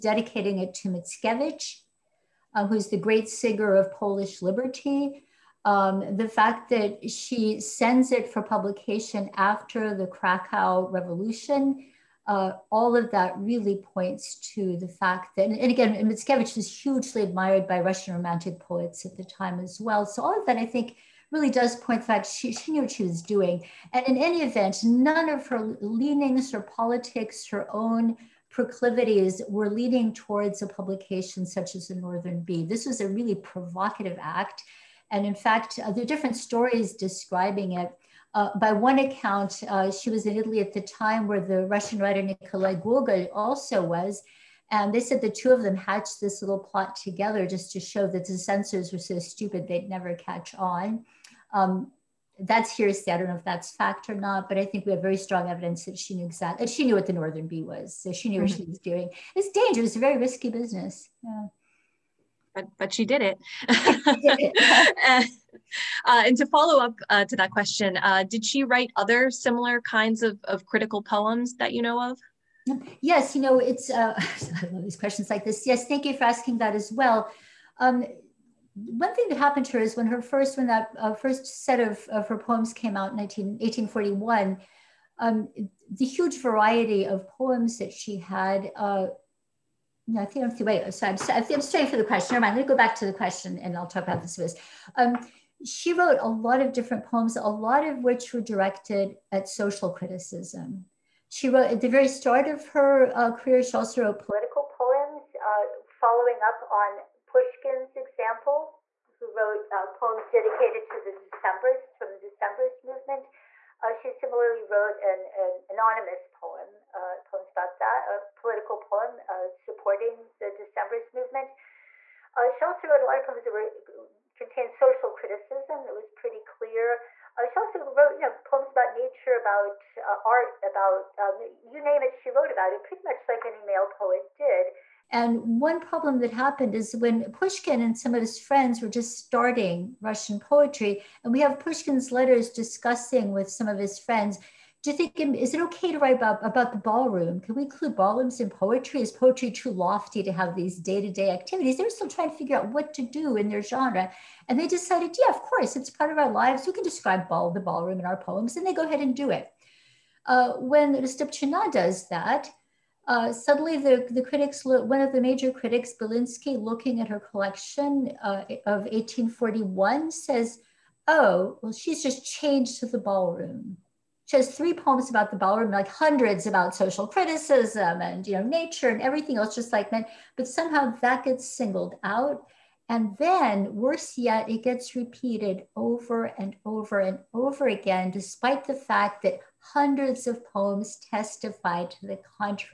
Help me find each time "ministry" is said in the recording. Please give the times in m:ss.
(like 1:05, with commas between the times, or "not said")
not said.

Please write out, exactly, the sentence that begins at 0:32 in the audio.
This was a really provocative act and in fact, uh, there are different stories describing it.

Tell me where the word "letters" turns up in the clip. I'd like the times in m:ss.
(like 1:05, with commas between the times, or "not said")
2:22.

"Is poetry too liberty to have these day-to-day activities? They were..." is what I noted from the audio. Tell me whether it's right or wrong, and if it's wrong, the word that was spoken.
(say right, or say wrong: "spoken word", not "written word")
wrong: "lofty", not "liberty".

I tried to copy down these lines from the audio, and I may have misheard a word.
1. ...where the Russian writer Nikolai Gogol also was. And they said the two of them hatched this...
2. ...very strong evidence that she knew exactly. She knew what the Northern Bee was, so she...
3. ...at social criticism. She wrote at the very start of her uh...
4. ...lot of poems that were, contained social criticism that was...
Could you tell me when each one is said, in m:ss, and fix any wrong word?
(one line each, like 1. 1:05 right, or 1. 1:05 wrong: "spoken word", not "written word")
1. 0:41 right
2. 0:55 right
3. 1:39 right
4. 2:03 right.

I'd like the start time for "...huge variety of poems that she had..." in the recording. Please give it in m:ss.
1:26.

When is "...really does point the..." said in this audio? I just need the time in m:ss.
0:21.